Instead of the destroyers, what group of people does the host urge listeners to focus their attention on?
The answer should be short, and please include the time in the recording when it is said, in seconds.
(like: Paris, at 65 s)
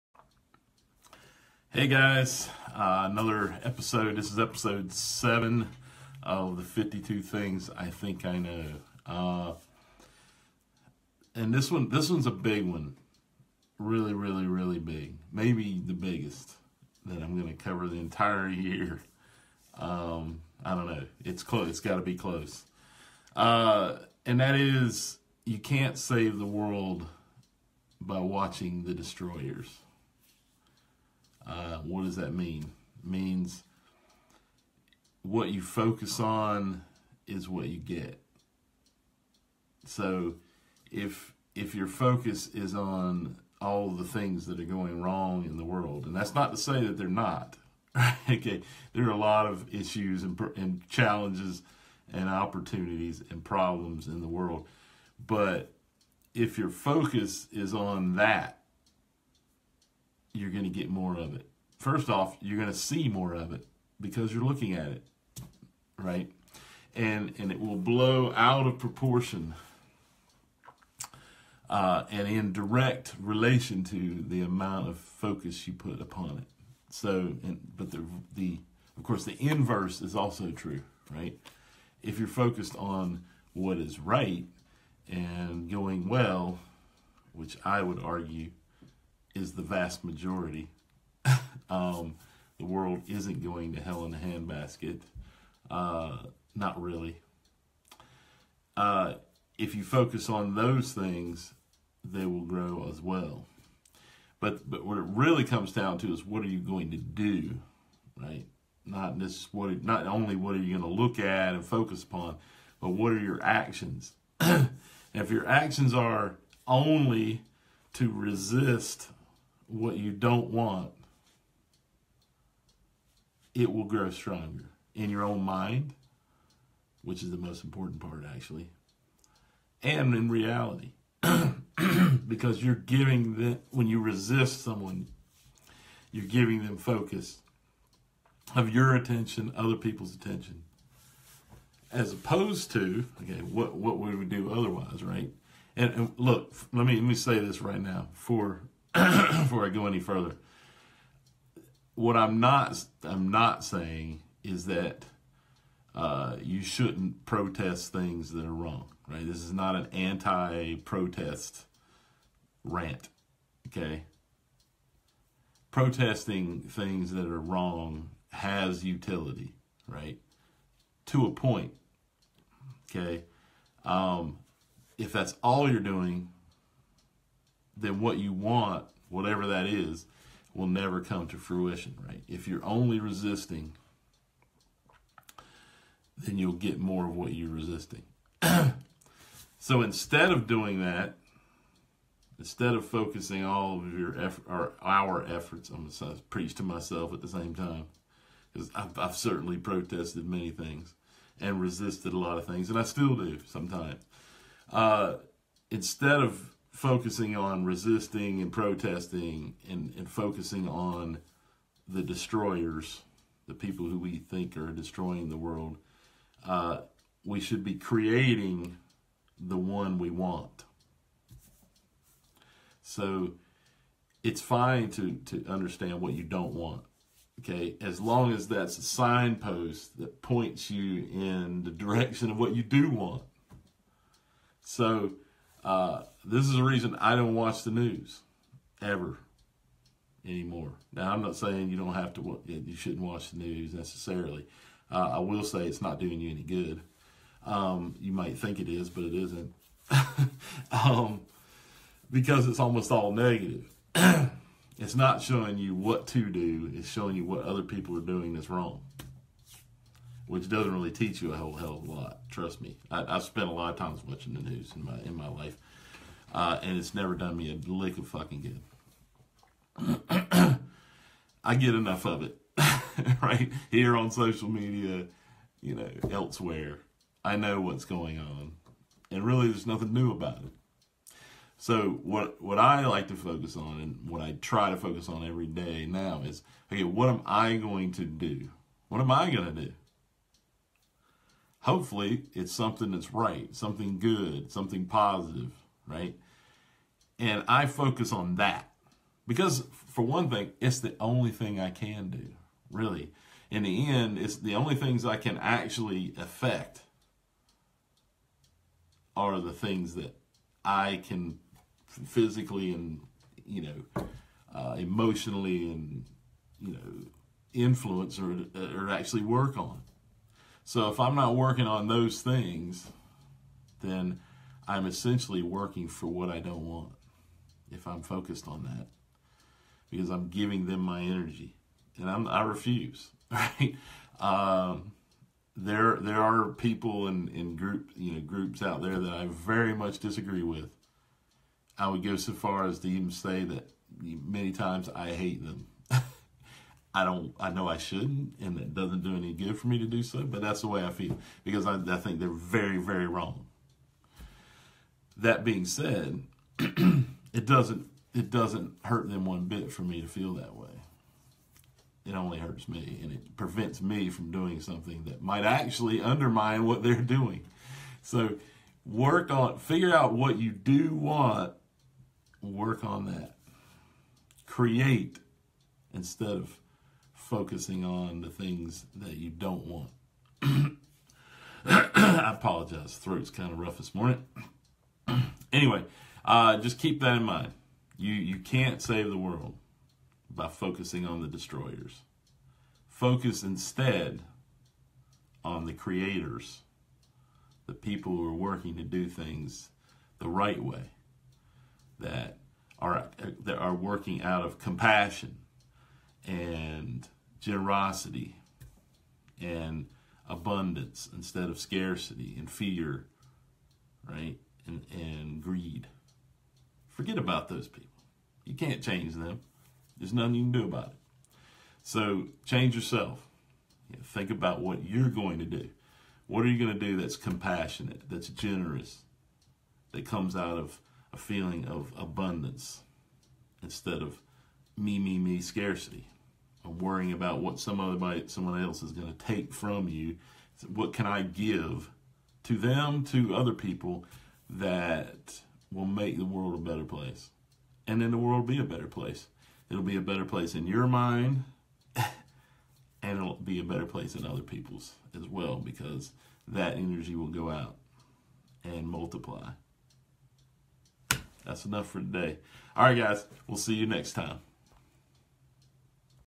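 the creators, at 395 s.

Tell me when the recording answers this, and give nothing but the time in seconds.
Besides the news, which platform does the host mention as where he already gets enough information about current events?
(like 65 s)
274 s.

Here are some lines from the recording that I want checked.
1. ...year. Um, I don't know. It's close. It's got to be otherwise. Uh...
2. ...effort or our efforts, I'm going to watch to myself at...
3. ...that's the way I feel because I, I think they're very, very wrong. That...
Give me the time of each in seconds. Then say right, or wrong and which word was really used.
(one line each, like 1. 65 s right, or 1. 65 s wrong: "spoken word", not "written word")
1. 18 s wrong: "close", not "otherwise"
2. 194 s wrong: "preach", not "watch"
3. 350 s right.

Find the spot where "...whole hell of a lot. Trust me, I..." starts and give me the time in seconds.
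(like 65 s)
261 s.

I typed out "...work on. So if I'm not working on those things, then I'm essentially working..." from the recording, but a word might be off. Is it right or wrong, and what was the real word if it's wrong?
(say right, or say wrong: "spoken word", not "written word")
right.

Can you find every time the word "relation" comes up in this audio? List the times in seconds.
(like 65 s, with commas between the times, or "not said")
73 s.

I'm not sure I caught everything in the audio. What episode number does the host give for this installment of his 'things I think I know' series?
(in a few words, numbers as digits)
7.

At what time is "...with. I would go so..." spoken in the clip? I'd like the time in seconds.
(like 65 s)
340 s.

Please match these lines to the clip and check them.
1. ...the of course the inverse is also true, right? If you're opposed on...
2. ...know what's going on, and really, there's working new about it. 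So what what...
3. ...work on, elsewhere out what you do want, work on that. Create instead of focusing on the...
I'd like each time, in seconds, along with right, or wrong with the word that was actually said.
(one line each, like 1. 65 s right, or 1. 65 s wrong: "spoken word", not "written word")
1. 78 s wrong: "focused", not "opposed"
2. 277 s wrong: "nothing", not "working"
3. 368 s wrong: "figure", not "elsewhere".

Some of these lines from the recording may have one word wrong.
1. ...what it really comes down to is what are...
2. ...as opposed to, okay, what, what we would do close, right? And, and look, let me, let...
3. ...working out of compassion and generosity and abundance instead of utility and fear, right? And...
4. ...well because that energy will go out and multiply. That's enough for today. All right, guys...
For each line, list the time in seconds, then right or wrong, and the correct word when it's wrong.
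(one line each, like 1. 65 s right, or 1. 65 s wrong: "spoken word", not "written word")
1. 104 s right
2. 141 s wrong: "otherwise", not "close"
3. 403 s wrong: "scarcity", not "utility"
4. 455 s right.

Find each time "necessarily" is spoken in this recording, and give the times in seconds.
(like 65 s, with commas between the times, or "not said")
243 s.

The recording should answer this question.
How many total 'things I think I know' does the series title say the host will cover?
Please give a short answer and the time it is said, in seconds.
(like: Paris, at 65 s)
52, at 6 s.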